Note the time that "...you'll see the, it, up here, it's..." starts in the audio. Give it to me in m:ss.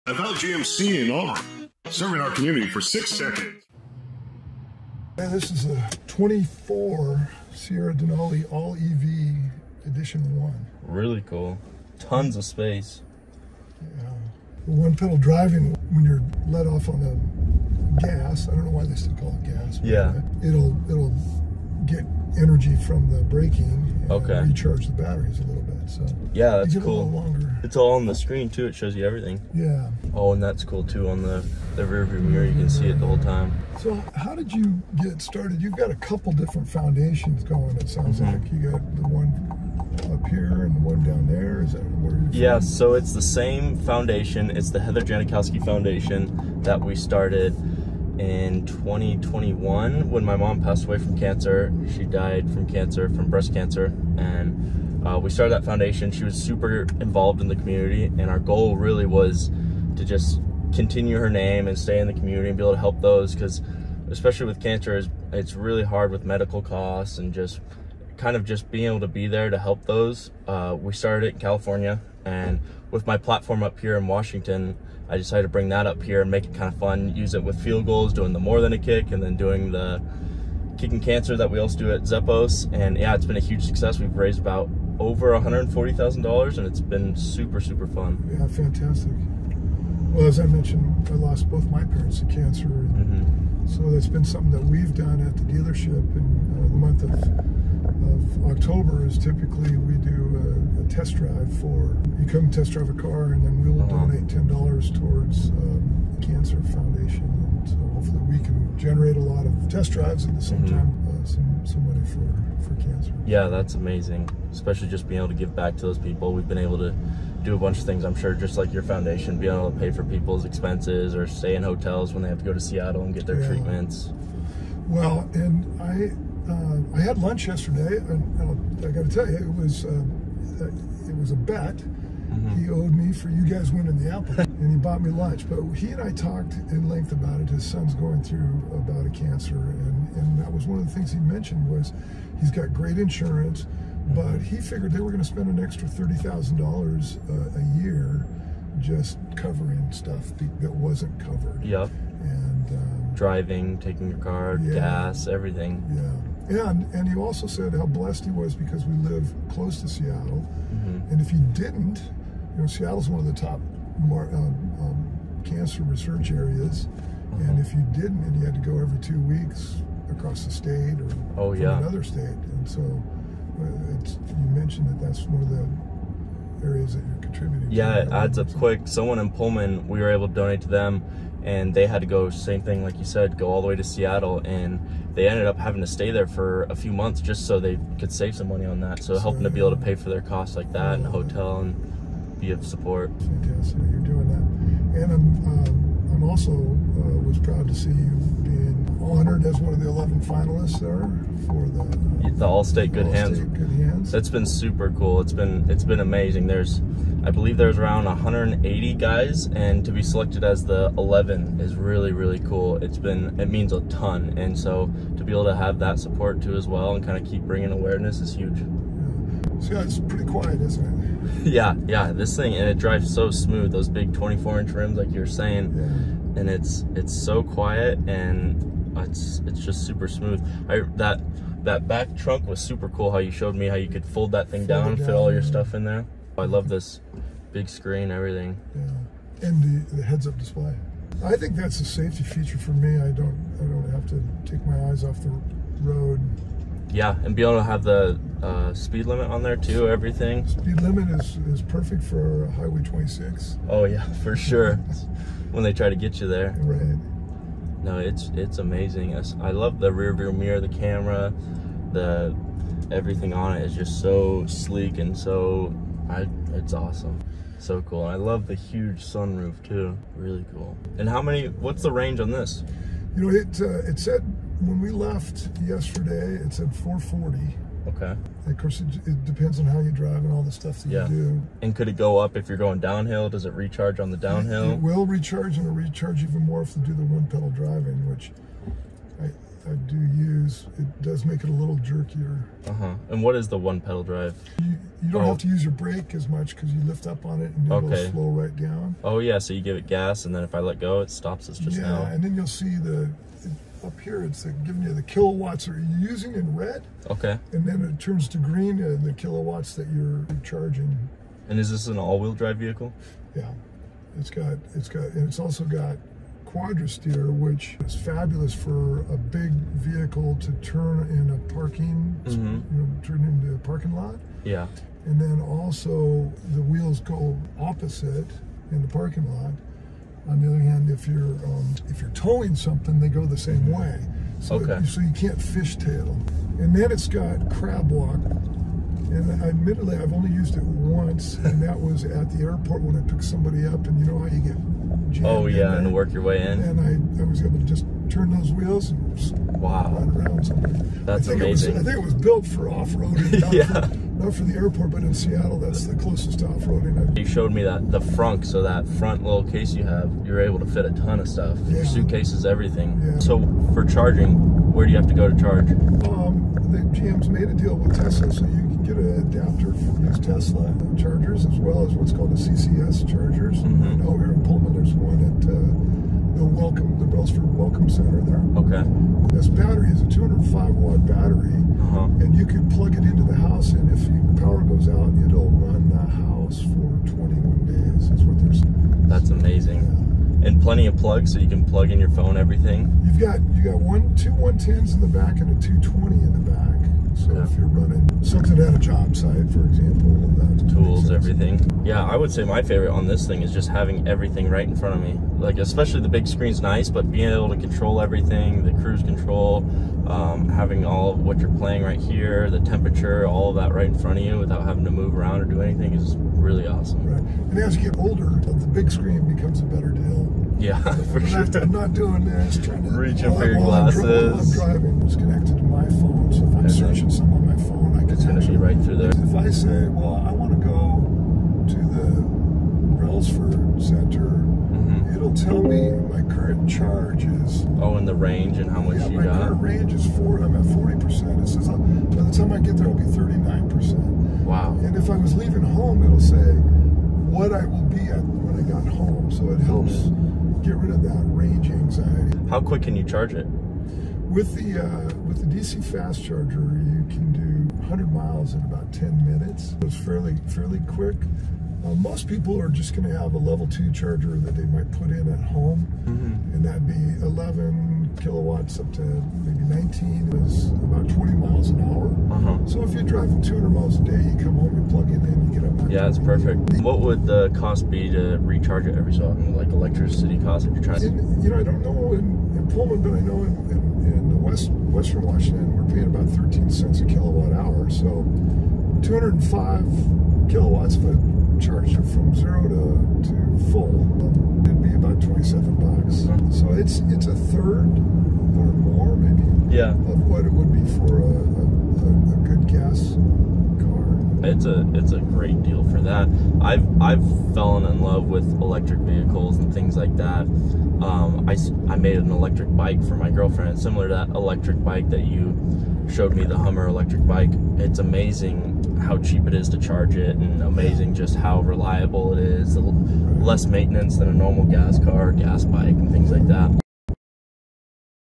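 5:02.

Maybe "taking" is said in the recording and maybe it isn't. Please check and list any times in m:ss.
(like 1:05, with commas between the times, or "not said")
2:33.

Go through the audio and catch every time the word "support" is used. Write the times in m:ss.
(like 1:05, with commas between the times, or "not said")
3:12, 3:35.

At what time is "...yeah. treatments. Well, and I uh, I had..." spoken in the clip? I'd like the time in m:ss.
2:03.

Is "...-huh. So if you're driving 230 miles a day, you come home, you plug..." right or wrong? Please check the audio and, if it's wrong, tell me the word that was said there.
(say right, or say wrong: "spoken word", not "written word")
wrong: "200", not "230".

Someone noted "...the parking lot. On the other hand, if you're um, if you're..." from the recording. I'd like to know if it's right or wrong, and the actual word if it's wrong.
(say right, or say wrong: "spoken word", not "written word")
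right.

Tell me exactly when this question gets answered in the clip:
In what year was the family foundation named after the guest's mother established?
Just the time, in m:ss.
0:48.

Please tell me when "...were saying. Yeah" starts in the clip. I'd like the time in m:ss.
3:45.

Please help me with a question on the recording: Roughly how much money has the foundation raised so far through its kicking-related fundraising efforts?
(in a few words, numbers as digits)
over $140,000.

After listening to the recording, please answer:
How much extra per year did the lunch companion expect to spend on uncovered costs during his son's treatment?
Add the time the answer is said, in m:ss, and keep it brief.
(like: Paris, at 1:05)
$30,000, at 2:25.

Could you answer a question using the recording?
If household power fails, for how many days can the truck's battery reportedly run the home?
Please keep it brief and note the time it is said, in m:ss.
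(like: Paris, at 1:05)
21 days, at 6:27.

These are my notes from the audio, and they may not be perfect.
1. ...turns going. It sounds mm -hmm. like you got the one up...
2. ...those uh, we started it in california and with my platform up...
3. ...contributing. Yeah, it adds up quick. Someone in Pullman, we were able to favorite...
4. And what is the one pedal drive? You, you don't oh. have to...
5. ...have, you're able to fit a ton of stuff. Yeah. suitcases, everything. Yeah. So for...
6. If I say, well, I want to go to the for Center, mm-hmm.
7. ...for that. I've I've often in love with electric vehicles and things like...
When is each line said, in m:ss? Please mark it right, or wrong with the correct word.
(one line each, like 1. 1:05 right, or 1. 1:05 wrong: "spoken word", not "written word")
1. 0:36 wrong: "foundations", not "turns"
2. 1:09 right
3. 2:57 wrong: "donate", not "favorite"
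4. 4:53 right
5. 5:59 right
6. 7:09 right
7. 8:25 wrong: "fallen", not "often".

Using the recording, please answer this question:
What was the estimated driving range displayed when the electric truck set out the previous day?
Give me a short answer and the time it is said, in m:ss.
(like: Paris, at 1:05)
440, at 4:36.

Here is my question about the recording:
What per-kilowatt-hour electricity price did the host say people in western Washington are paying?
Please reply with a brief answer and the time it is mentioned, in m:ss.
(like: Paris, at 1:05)
13 cents, at 8:06.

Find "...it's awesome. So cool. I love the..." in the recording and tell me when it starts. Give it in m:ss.
4:26.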